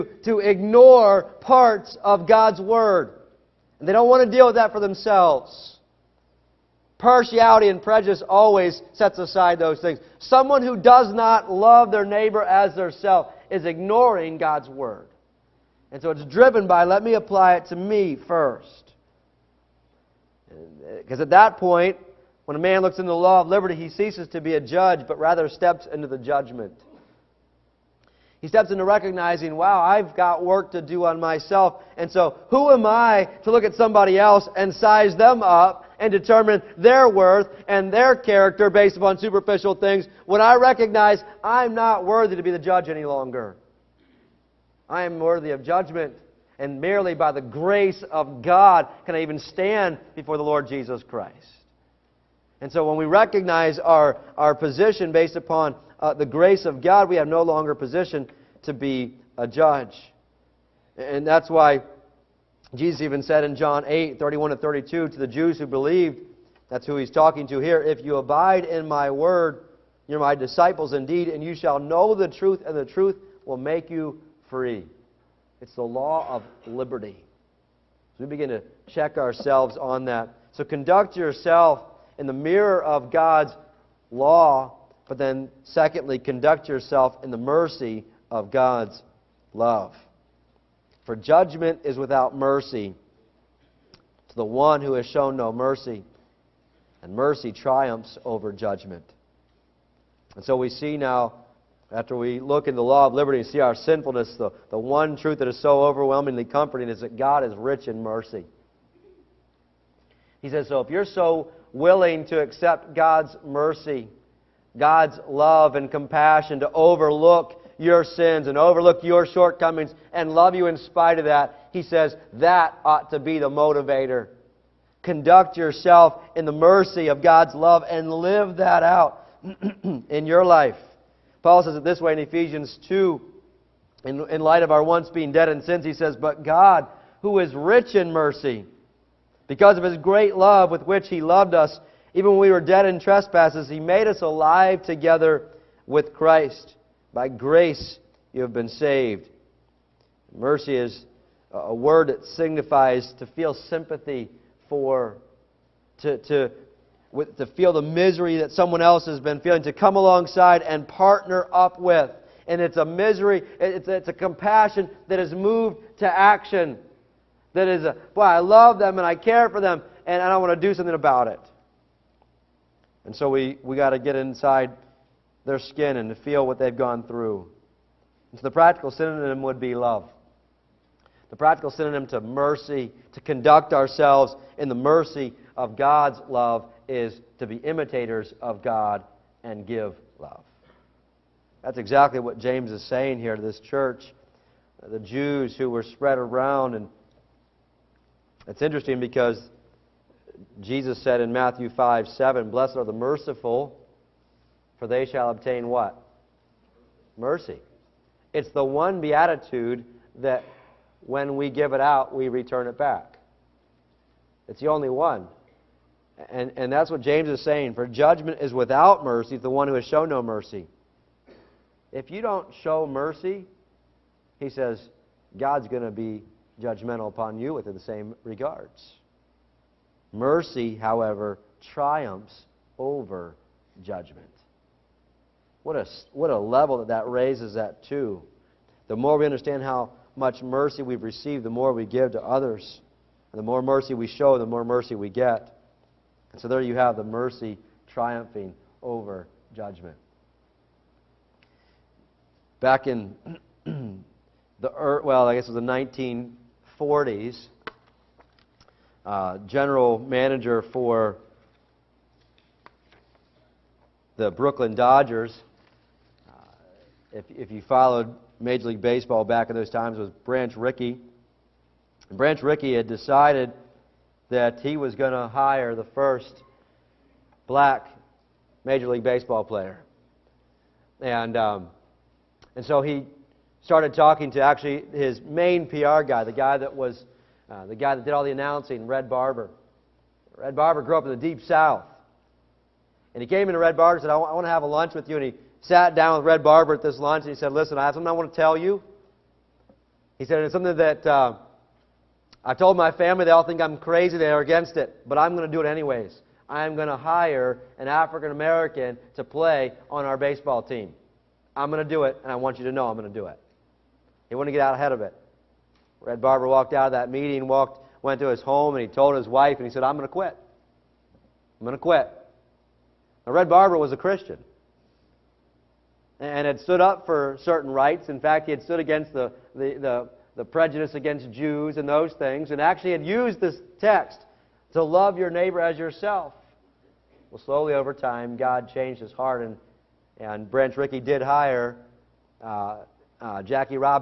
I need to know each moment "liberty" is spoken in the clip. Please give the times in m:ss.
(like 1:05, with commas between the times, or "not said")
0:23, 1:16, 1:43.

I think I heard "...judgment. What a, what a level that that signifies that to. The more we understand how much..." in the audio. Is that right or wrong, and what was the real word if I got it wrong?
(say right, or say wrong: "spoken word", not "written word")
wrong: "raises", not "signifies".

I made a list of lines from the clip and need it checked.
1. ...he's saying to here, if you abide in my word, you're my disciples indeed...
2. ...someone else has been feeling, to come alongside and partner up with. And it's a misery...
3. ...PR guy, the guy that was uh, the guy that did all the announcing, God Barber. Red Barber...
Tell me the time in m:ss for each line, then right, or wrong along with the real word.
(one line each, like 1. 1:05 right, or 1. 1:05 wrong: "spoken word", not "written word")
1. 1:06 wrong: "talking", not "saying"
2. 2:38 right
3. 4:45 wrong: "Red", not "God".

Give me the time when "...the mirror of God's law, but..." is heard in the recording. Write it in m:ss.
1:22.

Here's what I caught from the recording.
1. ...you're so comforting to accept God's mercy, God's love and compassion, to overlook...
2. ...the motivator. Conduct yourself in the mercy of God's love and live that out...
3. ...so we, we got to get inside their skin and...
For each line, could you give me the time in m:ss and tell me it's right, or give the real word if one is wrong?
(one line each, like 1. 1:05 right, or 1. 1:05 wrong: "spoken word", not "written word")
1. 1:50 wrong: "willing", not "comforting"
2. 2:03 right
3. 2:53 right.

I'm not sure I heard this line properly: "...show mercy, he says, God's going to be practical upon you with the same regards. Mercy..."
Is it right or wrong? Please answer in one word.
wrong.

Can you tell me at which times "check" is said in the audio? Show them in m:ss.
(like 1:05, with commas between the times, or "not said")
1:18.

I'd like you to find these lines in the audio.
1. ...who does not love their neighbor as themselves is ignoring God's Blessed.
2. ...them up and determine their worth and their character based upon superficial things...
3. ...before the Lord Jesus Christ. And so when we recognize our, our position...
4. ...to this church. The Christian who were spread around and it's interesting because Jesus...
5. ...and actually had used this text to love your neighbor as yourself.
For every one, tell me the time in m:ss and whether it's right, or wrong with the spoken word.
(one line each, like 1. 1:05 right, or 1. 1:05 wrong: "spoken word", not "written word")
1. 0:10 wrong: "Word", not "Blessed"
2. 0:35 right
3. 0:50 right
4. 3:13 wrong: "Jews", not "Christian"
5. 5:32 right.